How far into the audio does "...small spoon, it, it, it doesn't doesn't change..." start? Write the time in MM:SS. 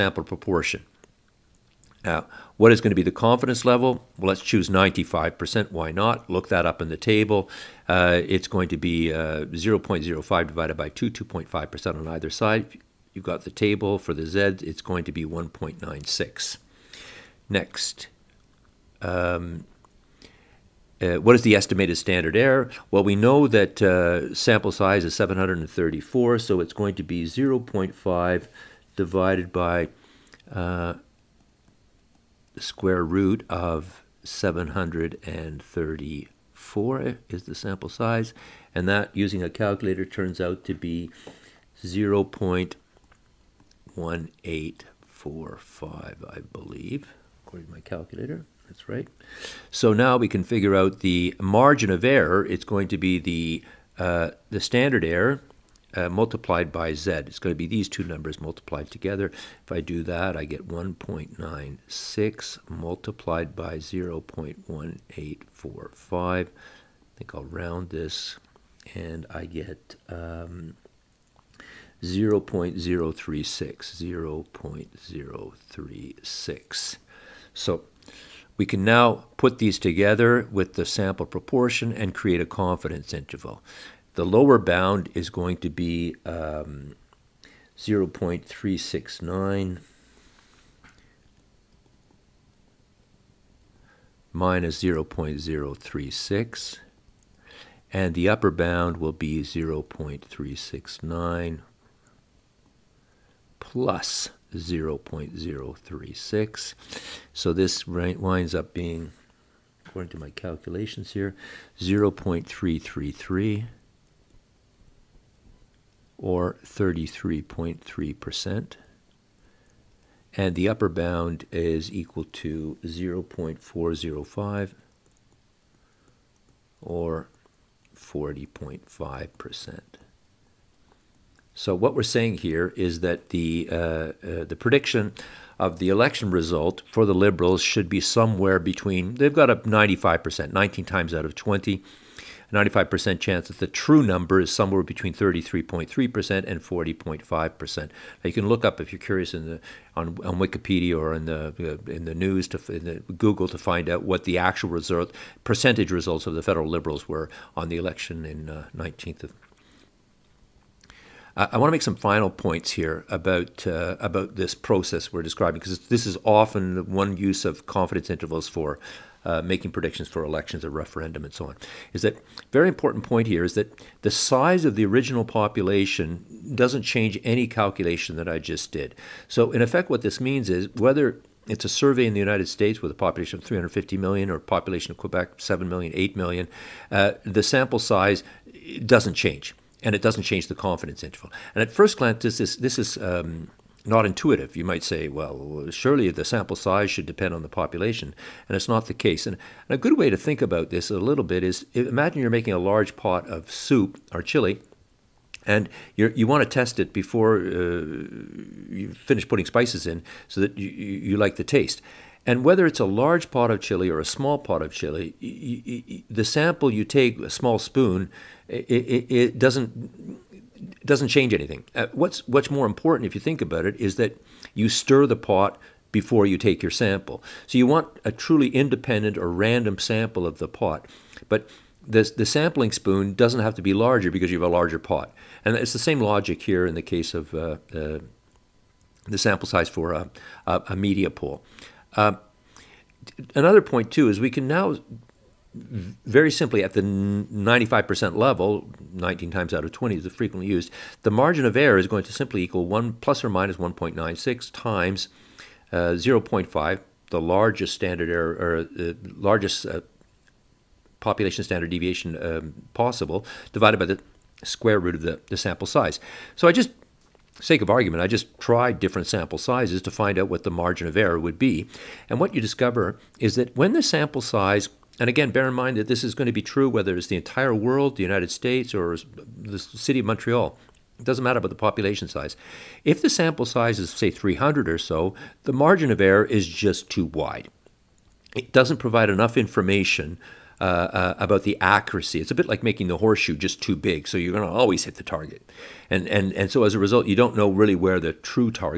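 03:37.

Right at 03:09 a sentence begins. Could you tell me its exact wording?
And it doesn't change the confidence interval.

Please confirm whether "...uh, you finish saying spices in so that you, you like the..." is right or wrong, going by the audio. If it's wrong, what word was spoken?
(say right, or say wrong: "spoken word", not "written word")
wrong: "putting", not "saying".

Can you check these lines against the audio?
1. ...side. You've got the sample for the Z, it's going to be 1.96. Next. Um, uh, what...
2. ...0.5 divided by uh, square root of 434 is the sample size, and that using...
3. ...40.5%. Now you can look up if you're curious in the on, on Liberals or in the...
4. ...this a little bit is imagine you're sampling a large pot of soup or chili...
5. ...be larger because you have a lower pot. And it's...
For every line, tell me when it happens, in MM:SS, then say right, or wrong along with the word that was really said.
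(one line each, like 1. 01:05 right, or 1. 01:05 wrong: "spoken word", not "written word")
1. 00:12 wrong: "table", not "sample"
2. 00:27 wrong: "734", not "434"
3. 02:26 wrong: "Wikipedia", not "Liberals"
4. 03:20 wrong: "making", not "sampling"
5. 03:53 wrong: "larger", not "lower".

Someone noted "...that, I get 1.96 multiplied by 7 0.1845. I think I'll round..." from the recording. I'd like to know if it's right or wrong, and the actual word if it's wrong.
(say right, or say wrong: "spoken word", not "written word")
wrong: "0", not "7".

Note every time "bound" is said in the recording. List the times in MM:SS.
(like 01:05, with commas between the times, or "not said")
01:24, 01:38, 02:00.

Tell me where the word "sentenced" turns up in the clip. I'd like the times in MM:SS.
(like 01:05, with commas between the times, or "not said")
not said.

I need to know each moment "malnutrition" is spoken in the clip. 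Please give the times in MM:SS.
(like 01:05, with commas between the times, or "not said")
not said.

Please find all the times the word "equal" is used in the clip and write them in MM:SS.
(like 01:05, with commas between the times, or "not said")
02:01, 04:12.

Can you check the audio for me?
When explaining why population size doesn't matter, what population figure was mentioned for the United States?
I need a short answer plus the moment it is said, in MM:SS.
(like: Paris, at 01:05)
350 million, at 03:03.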